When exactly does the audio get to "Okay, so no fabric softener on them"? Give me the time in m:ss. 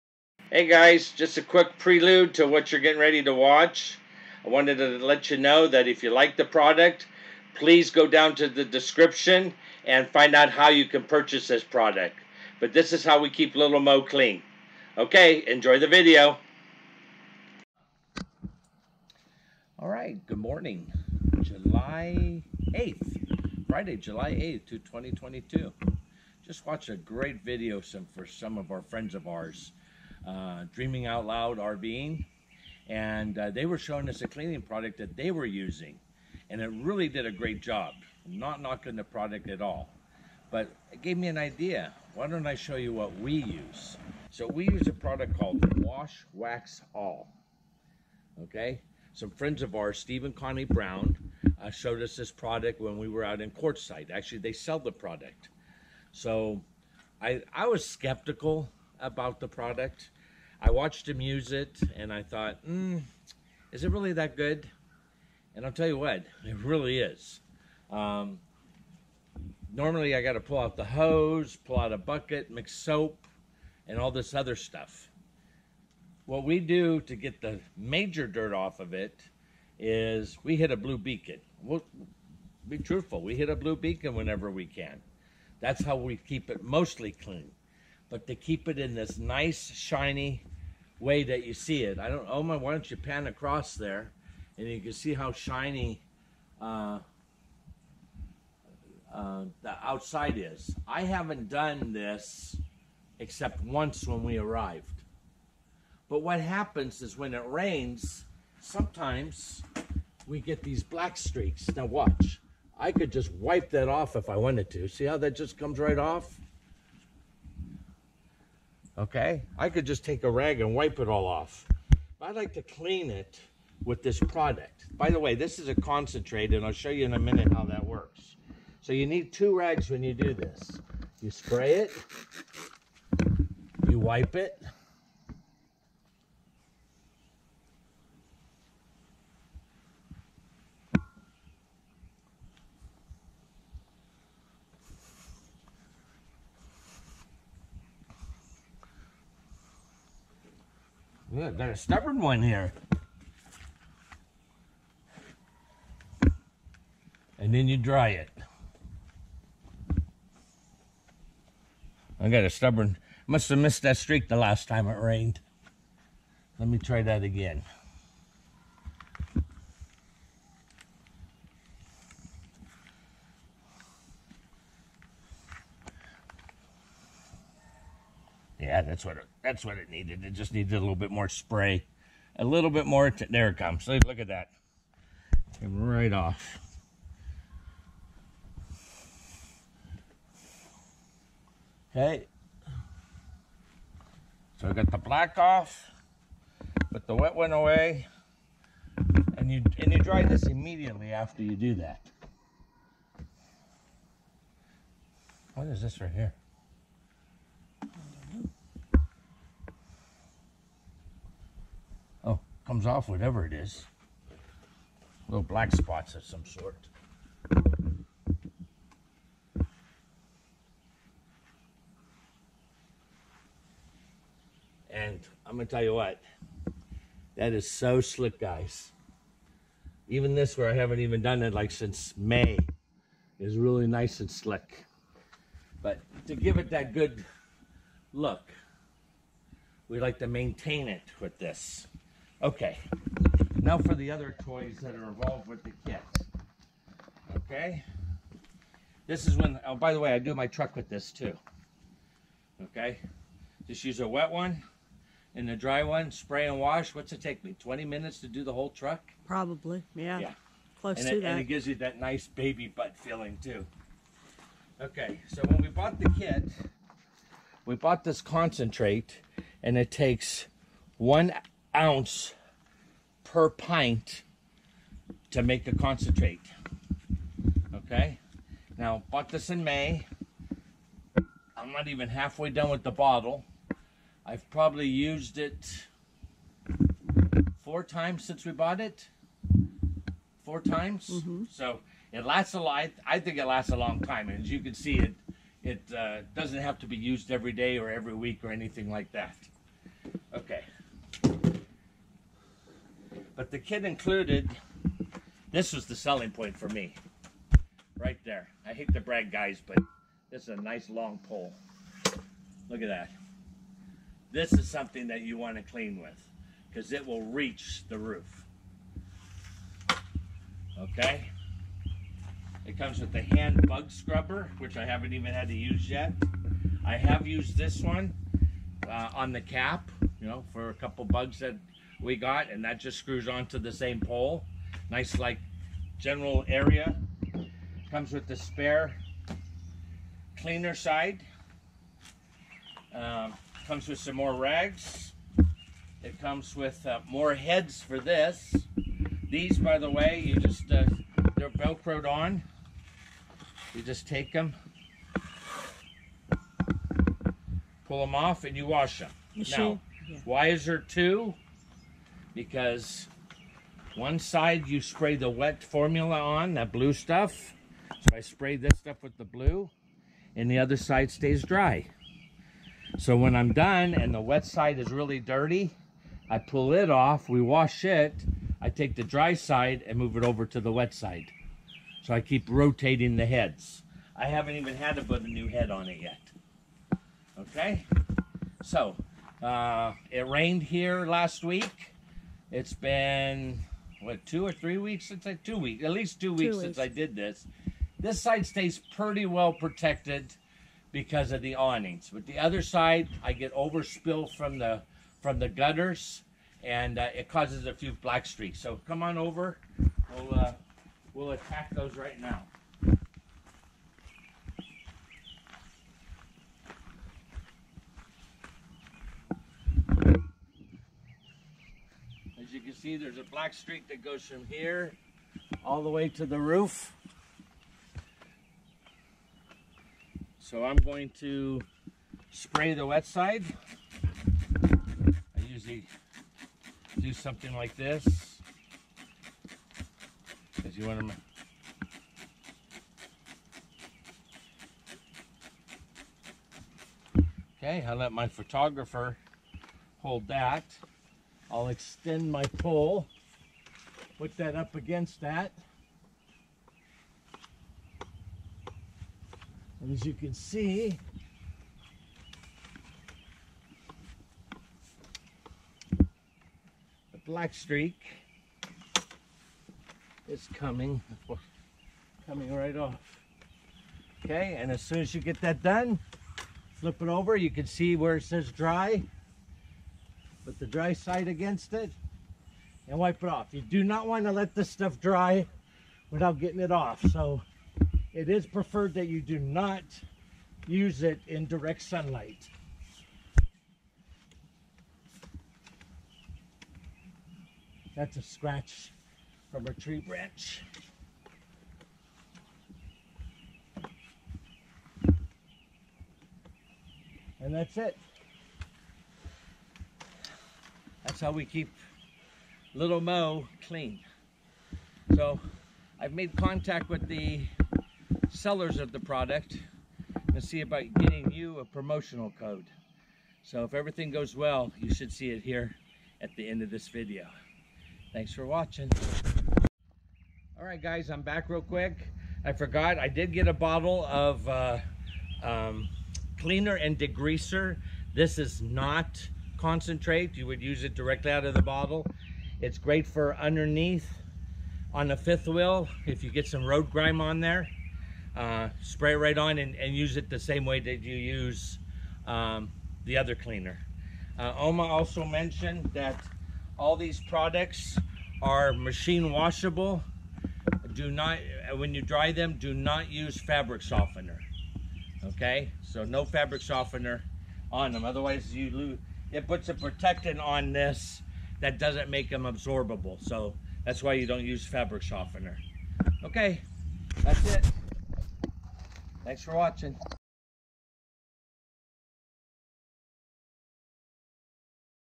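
9:25.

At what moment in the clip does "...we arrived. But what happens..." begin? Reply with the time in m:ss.
1:44.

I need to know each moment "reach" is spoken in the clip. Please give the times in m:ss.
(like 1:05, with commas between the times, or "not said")
5:17.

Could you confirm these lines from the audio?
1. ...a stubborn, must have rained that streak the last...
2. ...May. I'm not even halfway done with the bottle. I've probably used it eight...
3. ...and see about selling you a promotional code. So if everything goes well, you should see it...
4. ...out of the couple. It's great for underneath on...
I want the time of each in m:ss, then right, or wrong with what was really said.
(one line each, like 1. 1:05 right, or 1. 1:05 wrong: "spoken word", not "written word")
1. 2:42 wrong: "missed", not "rained"
2. 4:39 wrong: "four", not "eight"
3. 8:40 wrong: "getting", not "selling"
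4. 9:01 wrong: "bottle", not "couple".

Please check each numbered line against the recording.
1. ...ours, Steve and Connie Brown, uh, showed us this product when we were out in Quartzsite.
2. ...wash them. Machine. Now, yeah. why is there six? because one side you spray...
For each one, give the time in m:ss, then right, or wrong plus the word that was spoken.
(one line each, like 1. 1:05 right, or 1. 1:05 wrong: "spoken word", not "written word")
1. 0:49 right
2. 5:58 wrong: "two", not "six".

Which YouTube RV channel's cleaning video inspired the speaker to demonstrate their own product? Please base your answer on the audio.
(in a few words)
Dreaming Out Loud RVing.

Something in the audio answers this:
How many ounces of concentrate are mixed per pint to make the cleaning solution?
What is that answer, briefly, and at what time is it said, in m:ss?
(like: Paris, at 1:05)
1 ounce, at 4:30.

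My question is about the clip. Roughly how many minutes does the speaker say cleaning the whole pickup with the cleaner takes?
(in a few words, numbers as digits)
20 minutes.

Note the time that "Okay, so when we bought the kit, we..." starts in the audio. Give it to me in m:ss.
4:24.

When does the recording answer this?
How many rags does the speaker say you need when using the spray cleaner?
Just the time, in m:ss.
2:09.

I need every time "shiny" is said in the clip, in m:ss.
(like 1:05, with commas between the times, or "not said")
1:29, 1:35.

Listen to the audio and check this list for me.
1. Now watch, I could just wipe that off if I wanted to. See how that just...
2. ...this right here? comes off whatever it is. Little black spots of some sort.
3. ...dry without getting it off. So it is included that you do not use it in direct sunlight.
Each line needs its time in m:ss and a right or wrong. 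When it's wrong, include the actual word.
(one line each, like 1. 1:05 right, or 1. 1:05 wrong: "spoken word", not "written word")
1. 1:51 right
2. 3:25 right
3. 8:04 wrong: "preferred", not "included".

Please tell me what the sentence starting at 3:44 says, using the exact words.
And I'm gonna tell you what, that is so slick, guys.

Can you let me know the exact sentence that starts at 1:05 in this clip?
And I'll tell you what, it really is.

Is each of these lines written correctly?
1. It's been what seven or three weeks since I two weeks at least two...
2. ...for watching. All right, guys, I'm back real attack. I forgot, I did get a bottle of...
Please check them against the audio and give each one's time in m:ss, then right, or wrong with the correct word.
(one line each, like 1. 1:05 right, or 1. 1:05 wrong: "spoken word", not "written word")
1. 6:32 wrong: "two", not "seven"
2. 8:48 wrong: "quick", not "attack".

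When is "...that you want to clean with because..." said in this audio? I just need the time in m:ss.
5:15.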